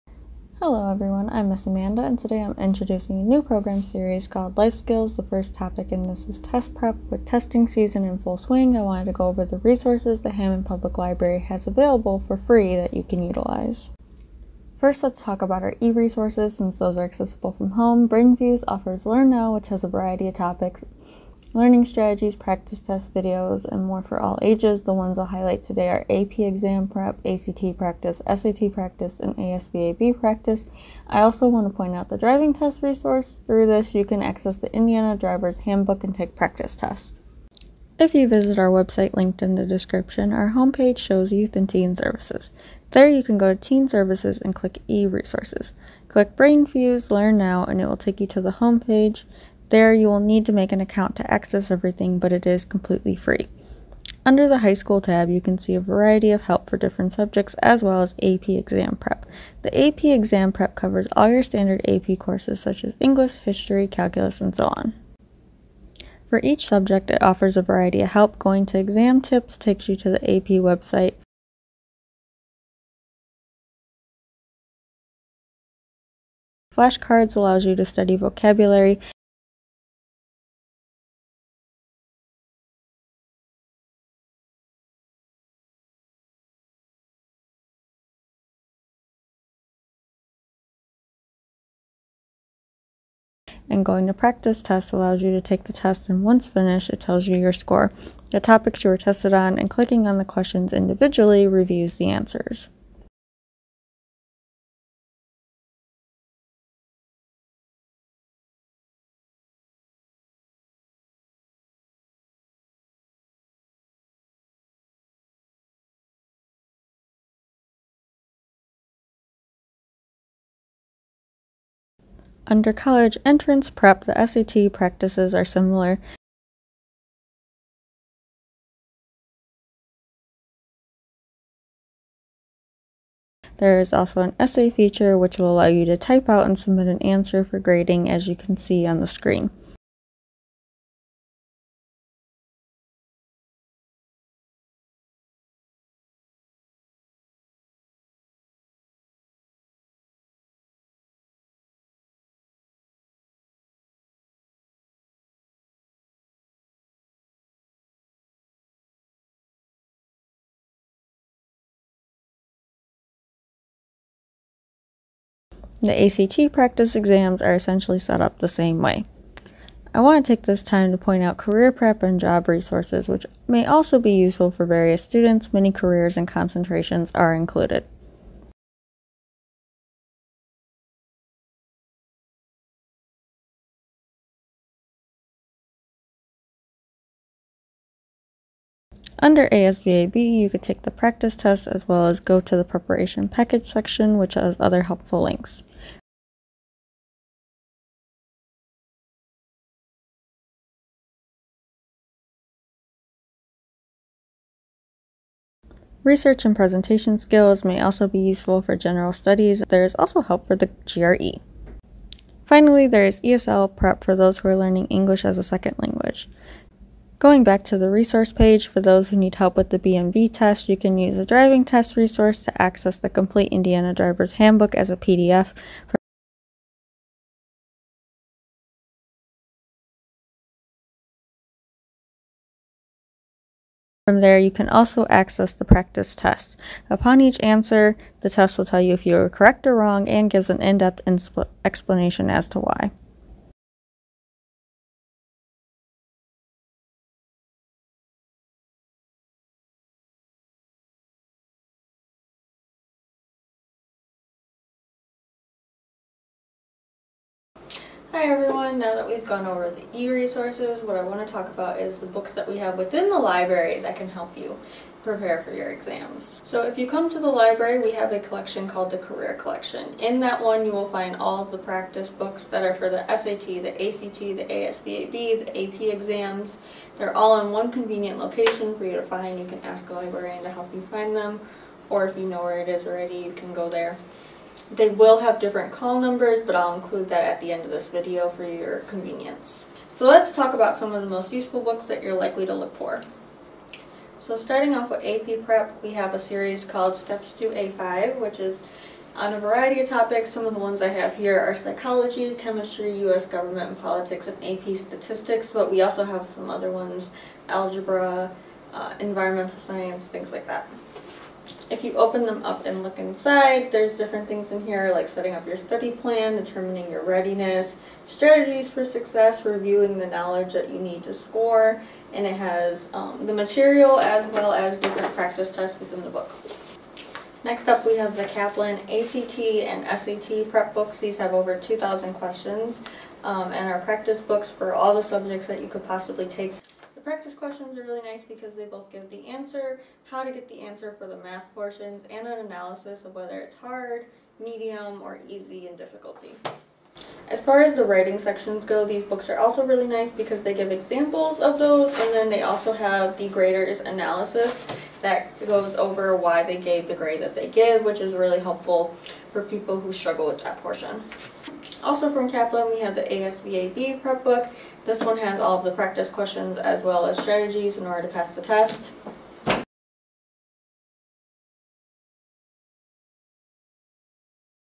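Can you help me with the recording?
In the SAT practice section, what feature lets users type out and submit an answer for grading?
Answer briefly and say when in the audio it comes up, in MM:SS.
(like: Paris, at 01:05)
essay feature, at 02:14.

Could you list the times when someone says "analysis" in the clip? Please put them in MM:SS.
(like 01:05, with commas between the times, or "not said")
05:42, 05:53.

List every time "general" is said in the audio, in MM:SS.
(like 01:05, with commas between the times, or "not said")
03:28.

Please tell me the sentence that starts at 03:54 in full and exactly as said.
From there, you can also access the practice test.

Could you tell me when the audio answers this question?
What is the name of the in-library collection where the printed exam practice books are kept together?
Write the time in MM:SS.
04:28.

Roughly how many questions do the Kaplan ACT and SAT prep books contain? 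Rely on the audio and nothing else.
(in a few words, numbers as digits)
over 2,000.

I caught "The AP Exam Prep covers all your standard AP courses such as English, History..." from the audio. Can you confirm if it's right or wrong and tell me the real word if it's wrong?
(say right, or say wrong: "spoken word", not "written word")
right.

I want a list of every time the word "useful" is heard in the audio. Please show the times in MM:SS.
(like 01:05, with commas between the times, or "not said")
02:54, 03:28, 04:51.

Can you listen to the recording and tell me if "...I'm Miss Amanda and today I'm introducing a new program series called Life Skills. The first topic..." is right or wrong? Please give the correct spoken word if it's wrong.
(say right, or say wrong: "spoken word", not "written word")
right.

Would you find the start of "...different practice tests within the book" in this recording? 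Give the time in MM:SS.
05:24.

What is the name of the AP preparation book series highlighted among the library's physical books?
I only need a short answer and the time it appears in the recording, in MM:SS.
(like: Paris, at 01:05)
Steps to A5, at 04:56.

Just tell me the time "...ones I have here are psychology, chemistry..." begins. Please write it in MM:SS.
05:00.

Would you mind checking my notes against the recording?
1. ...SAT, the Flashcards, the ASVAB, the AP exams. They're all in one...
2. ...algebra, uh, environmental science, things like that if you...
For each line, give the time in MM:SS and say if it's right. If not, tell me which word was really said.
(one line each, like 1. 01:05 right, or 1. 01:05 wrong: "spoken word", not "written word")
1. 04:33 wrong: "ACT", not "Flashcards"
2. 05:07 right.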